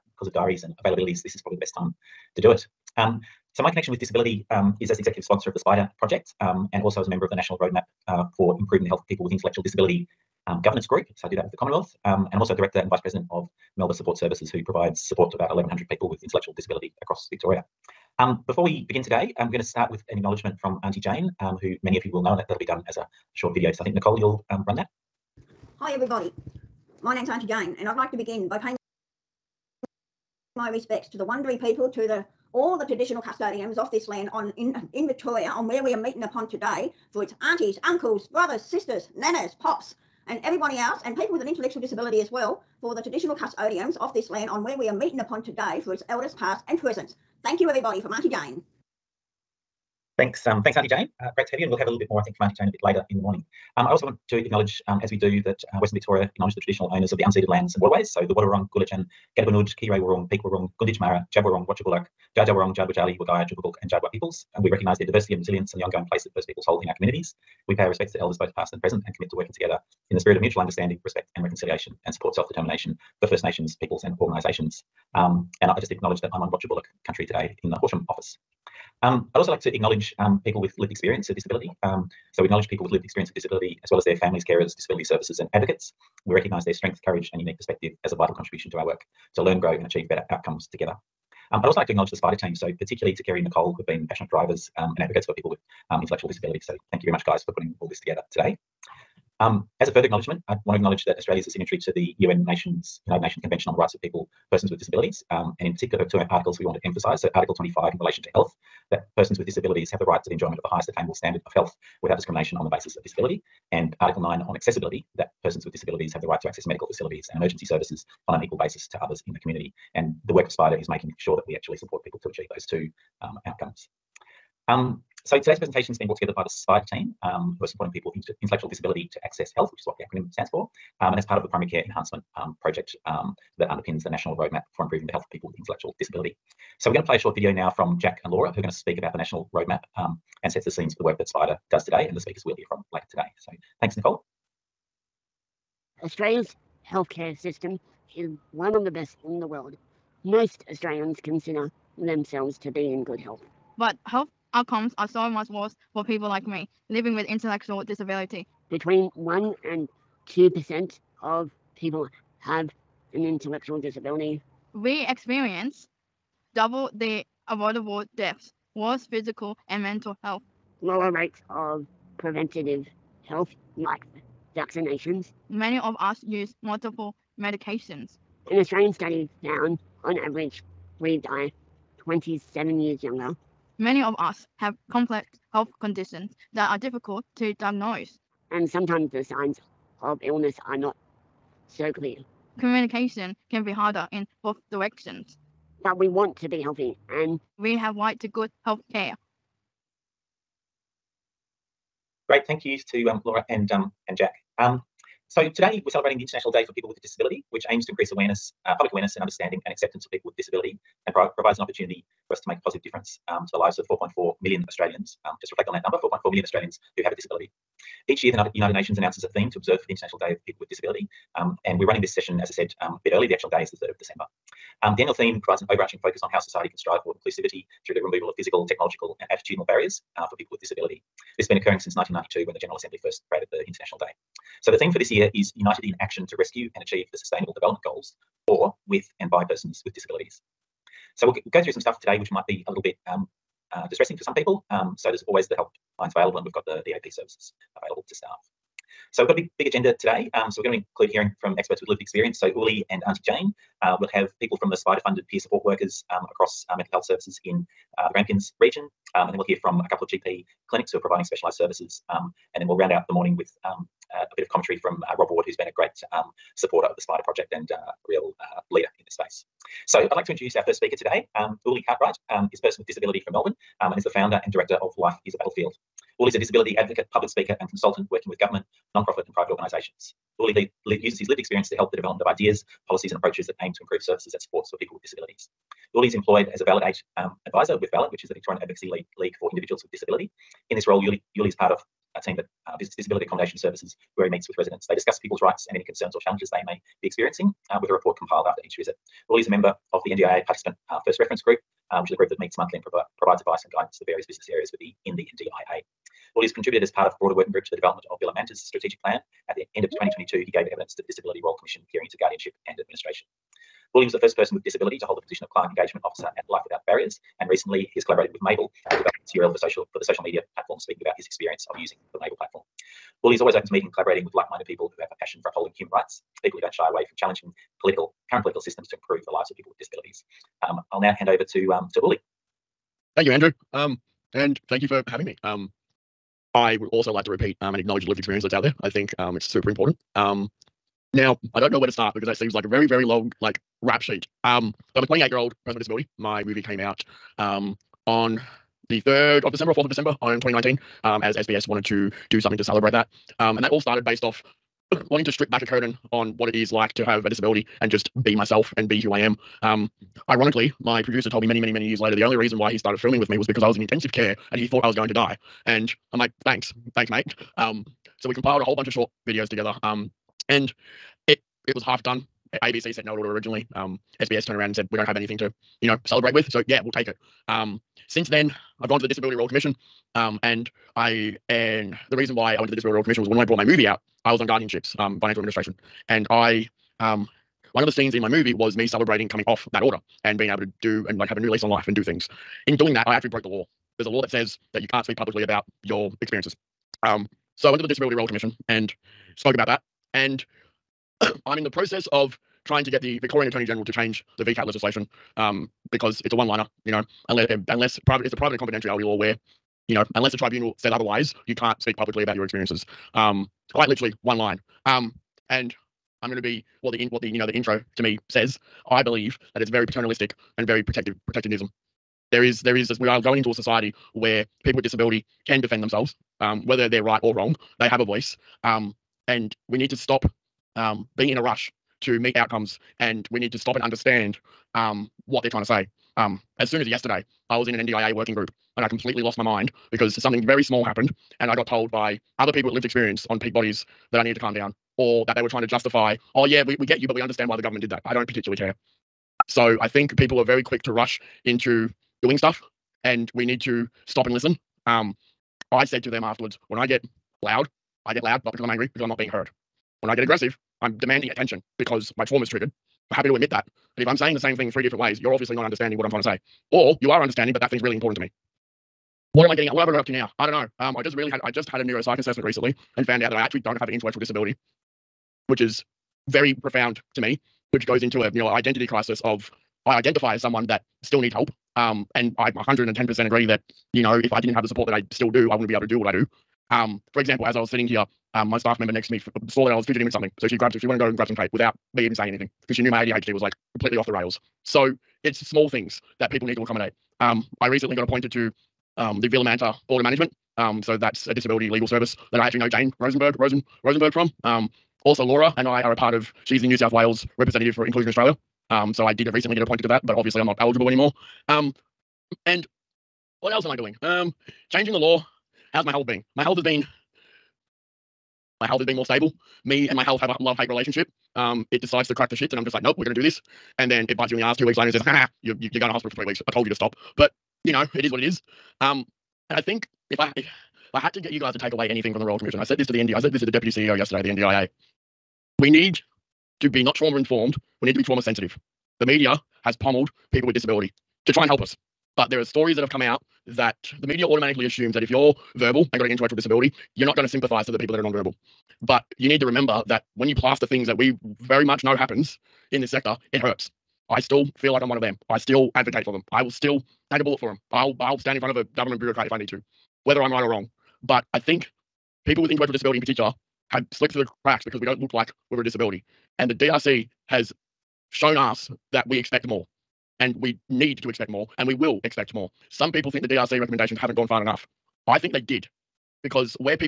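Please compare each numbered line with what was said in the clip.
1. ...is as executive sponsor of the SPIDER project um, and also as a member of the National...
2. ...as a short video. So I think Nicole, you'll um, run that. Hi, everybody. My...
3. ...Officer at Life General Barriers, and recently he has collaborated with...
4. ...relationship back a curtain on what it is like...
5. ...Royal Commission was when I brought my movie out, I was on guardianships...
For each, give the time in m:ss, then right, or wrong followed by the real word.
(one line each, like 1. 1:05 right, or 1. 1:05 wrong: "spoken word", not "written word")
1. 0:04 right
2. 0:22 right
3. 5:16 wrong: "Without", not "General"
4. 5:55 wrong: "strip", not "relationship"
5. 6:22 right.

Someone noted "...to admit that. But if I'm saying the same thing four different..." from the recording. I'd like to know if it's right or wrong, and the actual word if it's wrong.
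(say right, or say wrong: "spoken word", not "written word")
wrong: "three", not "four".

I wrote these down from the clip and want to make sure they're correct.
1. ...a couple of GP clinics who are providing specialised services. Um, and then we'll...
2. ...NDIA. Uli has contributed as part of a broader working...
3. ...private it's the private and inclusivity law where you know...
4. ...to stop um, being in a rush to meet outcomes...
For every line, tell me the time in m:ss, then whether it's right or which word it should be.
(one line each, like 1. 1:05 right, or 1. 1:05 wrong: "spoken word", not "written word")
1. 4:19 right
2. 5:05 right
3. 6:48 wrong: "confidentiality", not "inclusivity"
4. 7:09 right.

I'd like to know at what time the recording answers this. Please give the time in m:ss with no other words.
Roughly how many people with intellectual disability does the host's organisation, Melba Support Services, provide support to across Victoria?
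0:15.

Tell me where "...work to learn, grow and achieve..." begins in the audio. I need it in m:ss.
1:28.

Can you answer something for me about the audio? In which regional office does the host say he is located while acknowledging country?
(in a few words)
Horsham.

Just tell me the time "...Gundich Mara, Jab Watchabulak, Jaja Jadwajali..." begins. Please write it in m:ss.
1:00.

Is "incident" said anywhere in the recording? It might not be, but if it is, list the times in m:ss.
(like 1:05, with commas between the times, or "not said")
not said.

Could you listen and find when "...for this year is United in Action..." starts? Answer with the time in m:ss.
3:54.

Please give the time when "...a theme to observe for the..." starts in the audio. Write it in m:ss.
3:39.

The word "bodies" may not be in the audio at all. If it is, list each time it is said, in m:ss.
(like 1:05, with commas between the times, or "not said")
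7:23.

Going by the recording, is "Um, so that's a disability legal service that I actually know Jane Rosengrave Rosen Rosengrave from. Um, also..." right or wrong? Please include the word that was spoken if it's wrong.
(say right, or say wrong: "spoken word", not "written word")
right.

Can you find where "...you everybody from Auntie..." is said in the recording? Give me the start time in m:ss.
0:47.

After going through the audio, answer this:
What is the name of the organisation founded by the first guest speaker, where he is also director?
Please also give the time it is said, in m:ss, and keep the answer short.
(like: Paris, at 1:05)
Life is a Battlefield, at 4:34.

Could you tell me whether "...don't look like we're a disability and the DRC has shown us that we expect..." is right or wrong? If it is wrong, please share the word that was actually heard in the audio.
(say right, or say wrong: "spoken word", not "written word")
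right.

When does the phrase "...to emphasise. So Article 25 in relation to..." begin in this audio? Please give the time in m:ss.
1:46.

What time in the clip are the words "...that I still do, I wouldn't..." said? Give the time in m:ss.
8:04.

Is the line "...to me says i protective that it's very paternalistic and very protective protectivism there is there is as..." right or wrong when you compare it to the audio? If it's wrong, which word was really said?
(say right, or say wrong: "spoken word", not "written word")
wrong: "believe", not "protective".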